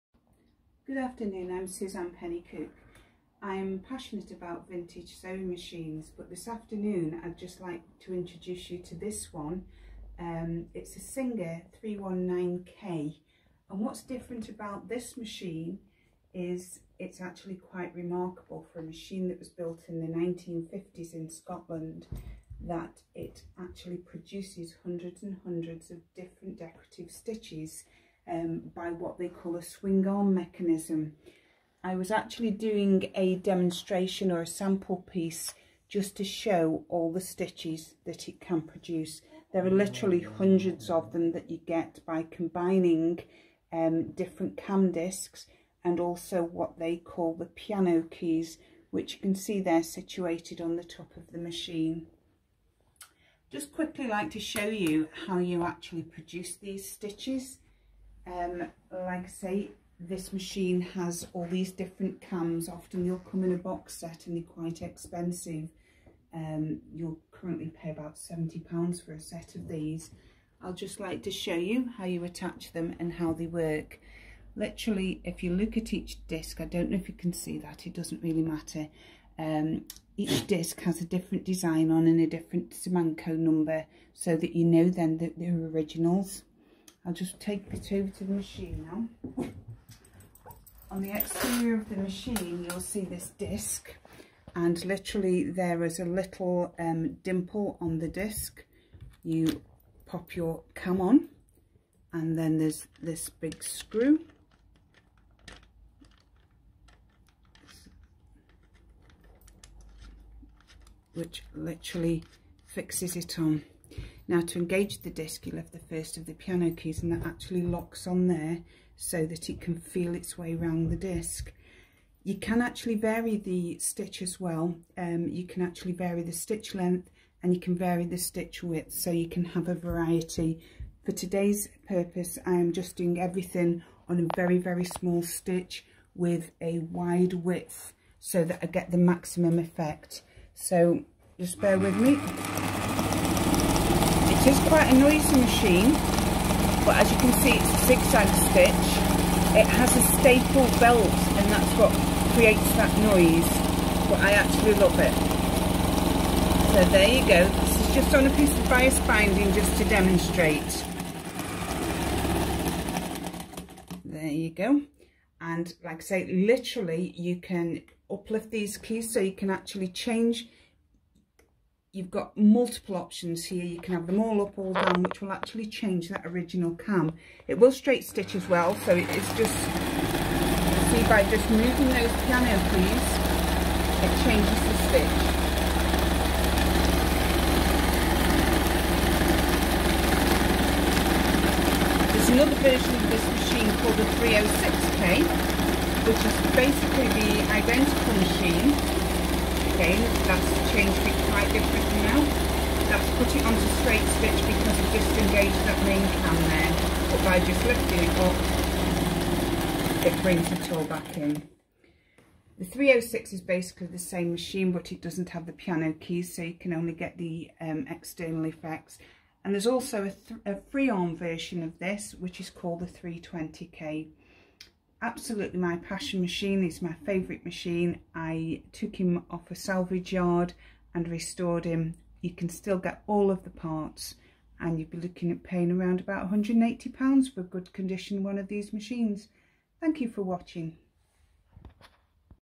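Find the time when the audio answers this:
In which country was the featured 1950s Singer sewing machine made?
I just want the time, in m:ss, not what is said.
0:21.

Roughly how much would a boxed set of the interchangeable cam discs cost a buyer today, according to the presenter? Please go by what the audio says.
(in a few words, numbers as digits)
£70.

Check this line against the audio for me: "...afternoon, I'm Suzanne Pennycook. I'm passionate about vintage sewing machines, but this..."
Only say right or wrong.
right.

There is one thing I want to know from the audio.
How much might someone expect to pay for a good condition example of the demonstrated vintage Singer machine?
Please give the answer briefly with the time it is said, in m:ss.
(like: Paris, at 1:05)
£180, at 3:56.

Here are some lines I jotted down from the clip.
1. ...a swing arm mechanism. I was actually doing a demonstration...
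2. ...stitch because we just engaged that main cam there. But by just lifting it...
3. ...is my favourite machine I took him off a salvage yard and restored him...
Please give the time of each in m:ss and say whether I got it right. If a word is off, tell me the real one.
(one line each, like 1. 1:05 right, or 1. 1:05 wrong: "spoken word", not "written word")
1. 0:29 right
2. 3:24 right
3. 3:46 right.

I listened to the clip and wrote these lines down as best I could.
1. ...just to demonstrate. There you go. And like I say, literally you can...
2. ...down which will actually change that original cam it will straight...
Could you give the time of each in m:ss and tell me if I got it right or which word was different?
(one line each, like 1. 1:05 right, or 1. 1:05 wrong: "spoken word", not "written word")
1. 2:39 right
2. 2:54 right.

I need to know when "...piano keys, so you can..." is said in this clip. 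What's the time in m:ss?
3:35.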